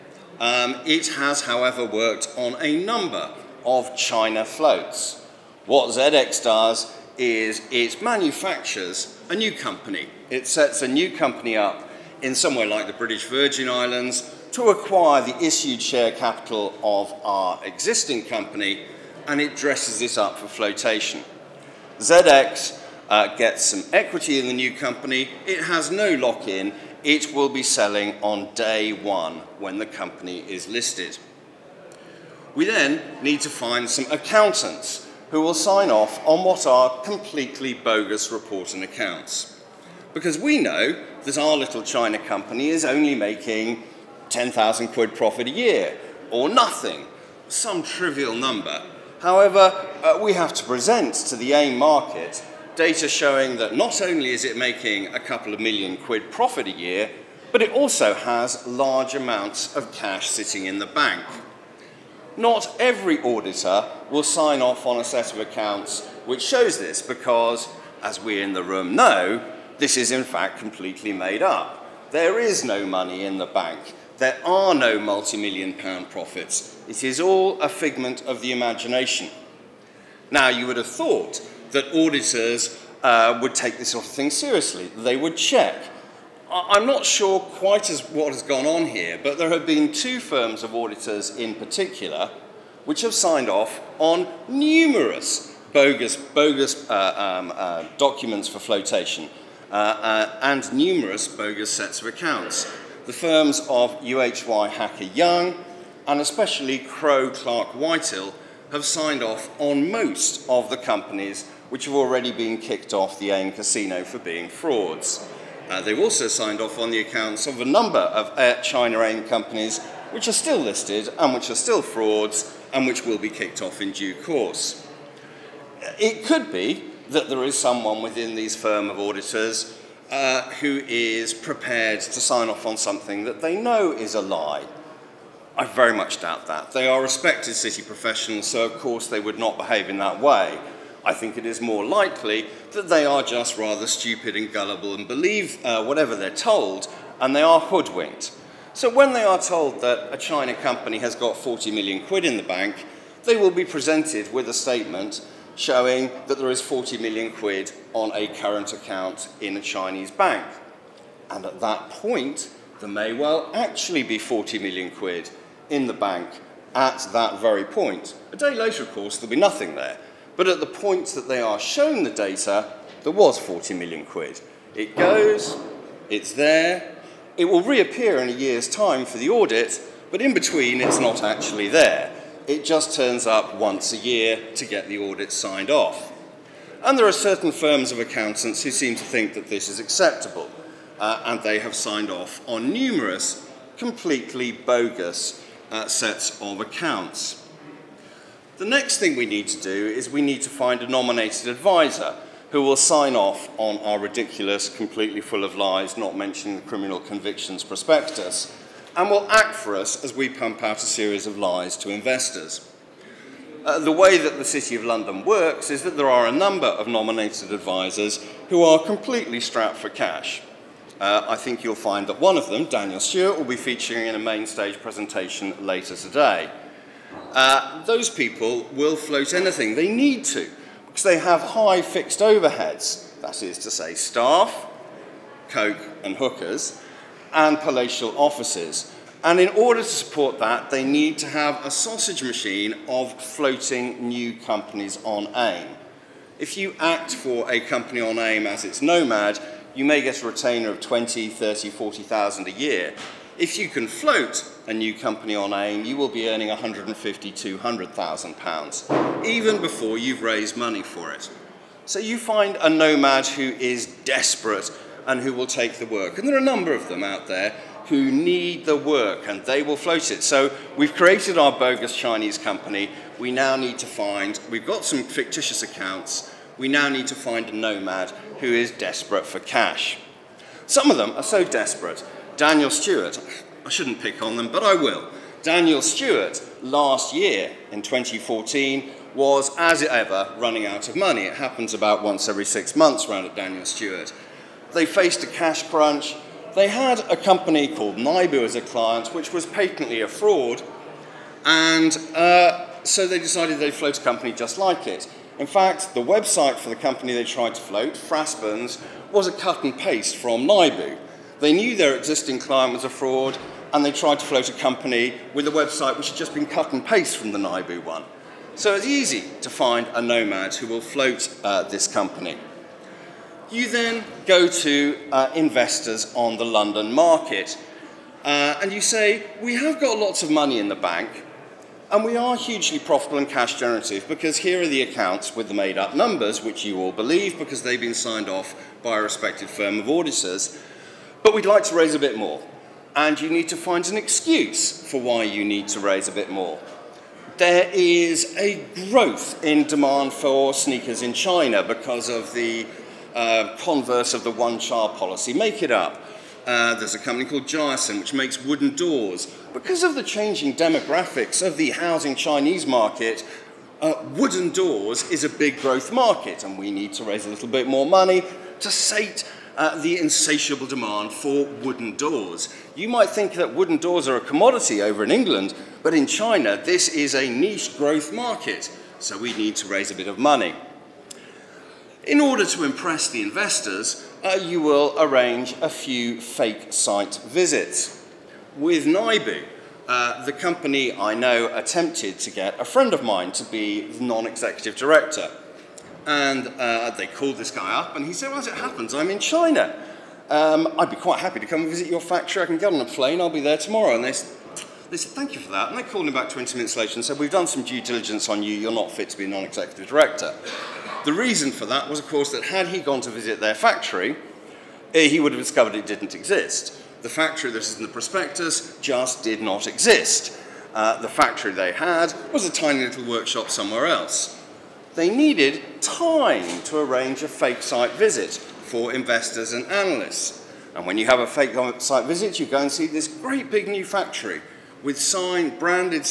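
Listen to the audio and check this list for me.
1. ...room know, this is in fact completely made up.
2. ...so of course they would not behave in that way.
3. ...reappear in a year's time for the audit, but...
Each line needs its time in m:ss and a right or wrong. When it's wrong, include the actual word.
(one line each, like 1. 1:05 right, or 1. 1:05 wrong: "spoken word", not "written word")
1. 1:08 right
2. 2:18 right
3. 2:57 right.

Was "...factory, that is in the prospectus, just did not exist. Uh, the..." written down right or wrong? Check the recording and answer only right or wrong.
right.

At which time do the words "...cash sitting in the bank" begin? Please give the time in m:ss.
0:59.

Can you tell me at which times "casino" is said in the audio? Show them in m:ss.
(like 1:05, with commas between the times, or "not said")
1:53.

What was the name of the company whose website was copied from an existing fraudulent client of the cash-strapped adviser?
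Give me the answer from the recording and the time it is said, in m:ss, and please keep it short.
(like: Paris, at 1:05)
Frasburns, at 5:07.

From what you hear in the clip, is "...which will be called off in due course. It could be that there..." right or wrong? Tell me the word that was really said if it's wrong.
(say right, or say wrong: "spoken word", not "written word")
wrong: "kicked", not "called".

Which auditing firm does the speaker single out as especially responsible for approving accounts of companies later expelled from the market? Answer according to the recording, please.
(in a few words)
Crowe Clark Whitehill.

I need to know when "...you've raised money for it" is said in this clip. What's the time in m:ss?
4:19.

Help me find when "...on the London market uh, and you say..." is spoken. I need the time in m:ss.
5:26.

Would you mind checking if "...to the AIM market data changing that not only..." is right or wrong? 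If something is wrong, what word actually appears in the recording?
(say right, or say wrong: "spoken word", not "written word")
wrong: "showing", not "changing".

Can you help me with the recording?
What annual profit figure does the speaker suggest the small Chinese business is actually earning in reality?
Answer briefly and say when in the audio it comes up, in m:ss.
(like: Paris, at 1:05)
10,000 quid, at 0:44.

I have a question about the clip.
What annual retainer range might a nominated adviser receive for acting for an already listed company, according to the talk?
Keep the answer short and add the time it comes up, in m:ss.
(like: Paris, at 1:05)
20, 30, 40,000, at 4:10.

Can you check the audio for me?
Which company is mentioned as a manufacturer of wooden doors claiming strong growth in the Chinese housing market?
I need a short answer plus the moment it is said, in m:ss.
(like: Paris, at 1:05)
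Gyerson, at 5:57.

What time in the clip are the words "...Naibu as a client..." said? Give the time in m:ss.
4:57.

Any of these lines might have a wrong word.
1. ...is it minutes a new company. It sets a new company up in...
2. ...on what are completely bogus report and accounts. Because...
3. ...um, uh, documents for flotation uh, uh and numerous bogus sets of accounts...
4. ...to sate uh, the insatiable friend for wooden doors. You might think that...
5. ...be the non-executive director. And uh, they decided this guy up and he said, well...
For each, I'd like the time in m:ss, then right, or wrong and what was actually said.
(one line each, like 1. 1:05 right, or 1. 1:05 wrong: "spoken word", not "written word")
1. 0:07 wrong: "manufactures", not "minutes"
2. 0:36 right
3. 1:37 right
4. 6:08 wrong: "demand", not "friend"
5. 6:33 wrong: "called", not "decided".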